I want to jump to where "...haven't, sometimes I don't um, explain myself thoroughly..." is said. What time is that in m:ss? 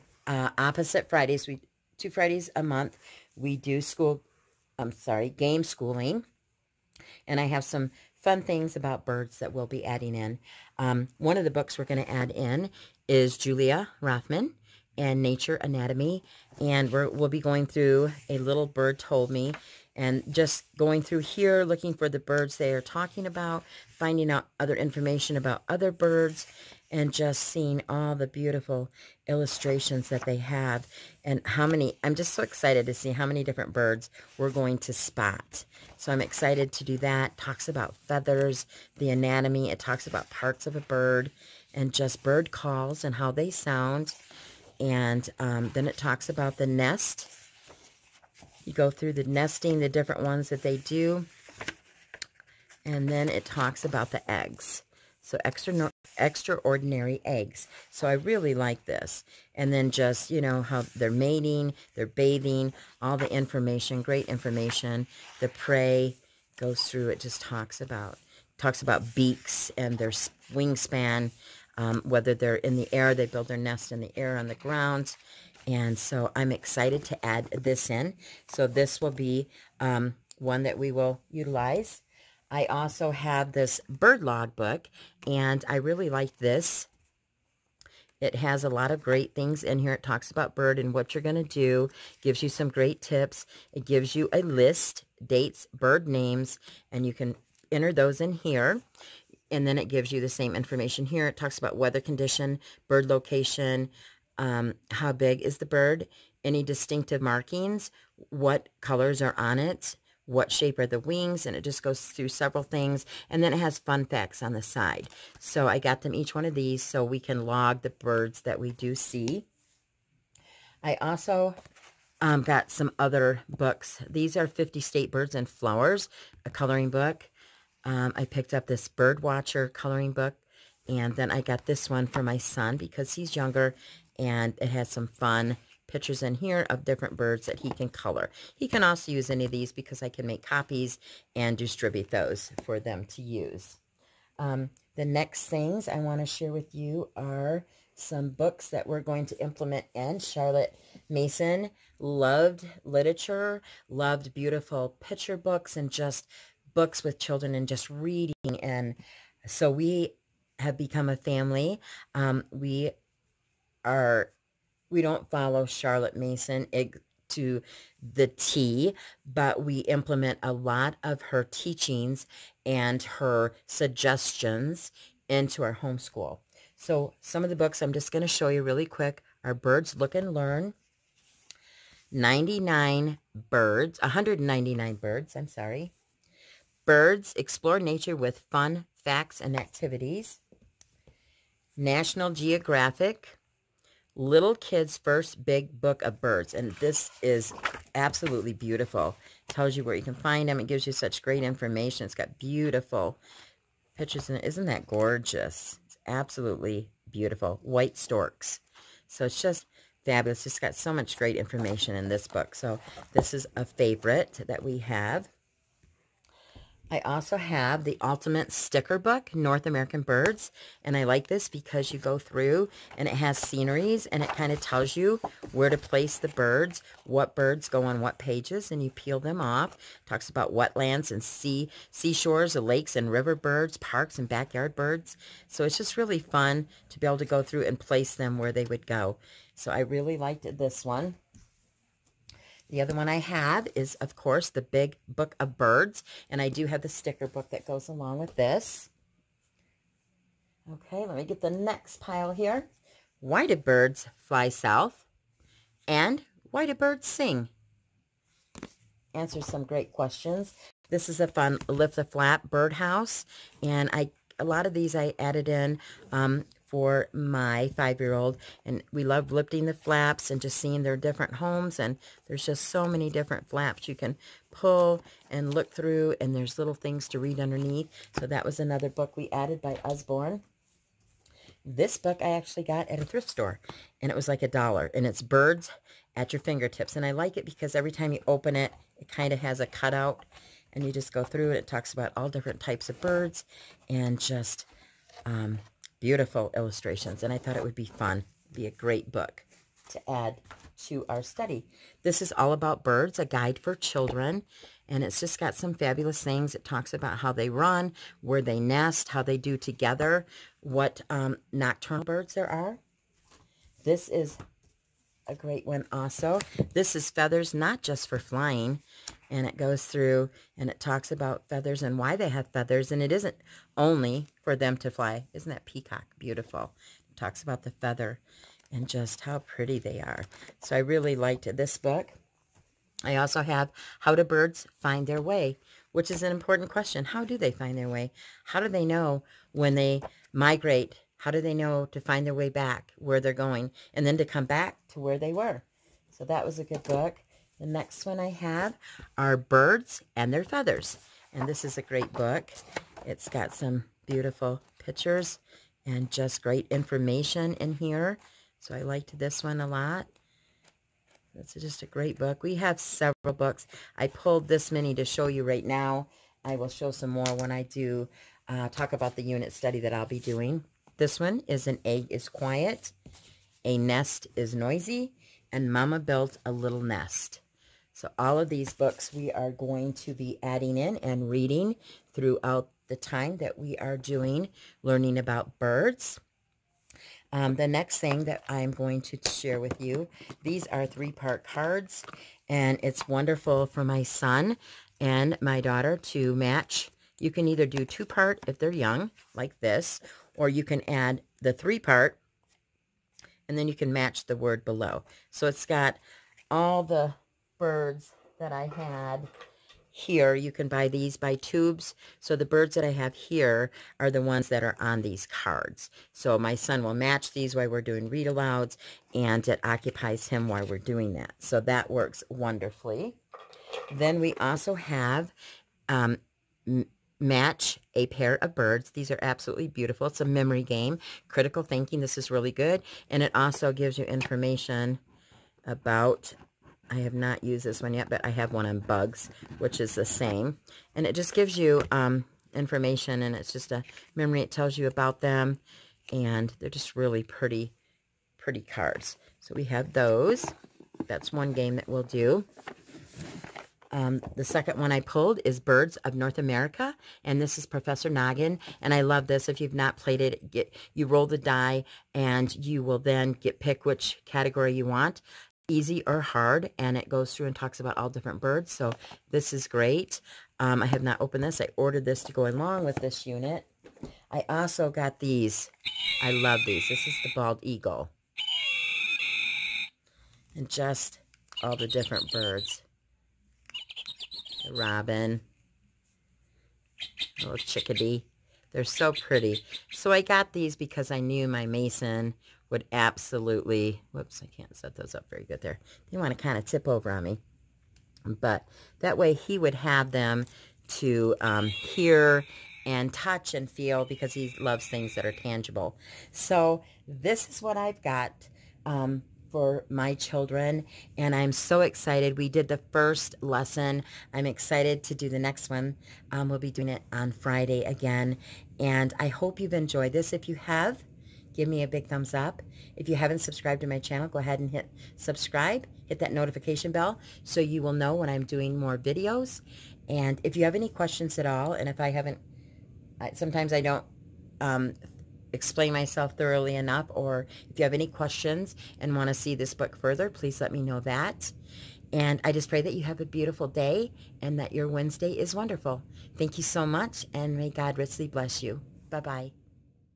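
8:52.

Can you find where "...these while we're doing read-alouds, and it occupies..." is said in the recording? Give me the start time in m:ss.
6:57.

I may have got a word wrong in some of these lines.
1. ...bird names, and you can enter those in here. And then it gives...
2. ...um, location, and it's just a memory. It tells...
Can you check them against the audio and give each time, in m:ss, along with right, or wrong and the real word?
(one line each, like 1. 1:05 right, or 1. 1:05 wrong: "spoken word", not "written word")
1. 1:35 right
2. 7:21 wrong: "information", not "location".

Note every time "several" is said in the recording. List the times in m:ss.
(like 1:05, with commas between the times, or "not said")
1:52, 6:02.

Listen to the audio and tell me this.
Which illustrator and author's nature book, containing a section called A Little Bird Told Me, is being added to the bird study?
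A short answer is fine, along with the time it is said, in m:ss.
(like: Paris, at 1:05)
Julia Rothman, at 0:13.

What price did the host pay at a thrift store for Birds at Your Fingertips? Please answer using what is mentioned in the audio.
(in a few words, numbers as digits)
a dollar.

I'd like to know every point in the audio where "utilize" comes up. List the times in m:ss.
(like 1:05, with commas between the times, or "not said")
1:21.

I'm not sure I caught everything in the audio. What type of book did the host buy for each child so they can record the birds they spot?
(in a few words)
bird log book.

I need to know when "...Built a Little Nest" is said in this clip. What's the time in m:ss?
6:16.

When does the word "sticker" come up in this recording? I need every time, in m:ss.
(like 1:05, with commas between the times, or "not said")
3:38, 4:06.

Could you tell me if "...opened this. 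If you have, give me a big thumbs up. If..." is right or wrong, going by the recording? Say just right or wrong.
wrong.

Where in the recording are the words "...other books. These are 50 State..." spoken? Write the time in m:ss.
2:02.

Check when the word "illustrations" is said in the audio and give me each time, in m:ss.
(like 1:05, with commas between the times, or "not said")
0:29, 4:56.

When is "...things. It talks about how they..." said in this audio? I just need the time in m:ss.
5:06.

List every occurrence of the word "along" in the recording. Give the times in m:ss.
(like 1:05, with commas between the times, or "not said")
4:07, 7:52.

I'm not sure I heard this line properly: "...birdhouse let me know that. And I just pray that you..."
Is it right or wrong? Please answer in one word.
wrong.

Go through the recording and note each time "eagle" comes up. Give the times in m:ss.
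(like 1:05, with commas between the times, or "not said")
7:57.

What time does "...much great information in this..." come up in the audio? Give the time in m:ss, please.
3:30.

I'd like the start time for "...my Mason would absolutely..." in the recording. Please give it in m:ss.
8:11.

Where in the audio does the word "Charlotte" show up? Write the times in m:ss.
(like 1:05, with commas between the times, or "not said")
2:30, 2:45.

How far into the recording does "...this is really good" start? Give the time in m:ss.
7:12.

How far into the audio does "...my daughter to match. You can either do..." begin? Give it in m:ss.
6:35.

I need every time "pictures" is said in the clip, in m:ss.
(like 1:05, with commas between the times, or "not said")
2:15, 2:35, 3:23, 5:54.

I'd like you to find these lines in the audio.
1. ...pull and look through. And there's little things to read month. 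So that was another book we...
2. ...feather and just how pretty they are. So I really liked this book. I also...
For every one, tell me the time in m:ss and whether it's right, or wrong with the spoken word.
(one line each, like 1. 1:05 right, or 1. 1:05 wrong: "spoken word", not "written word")
1. 4:34 wrong: "underneath", not "month"
2. 5:27 right.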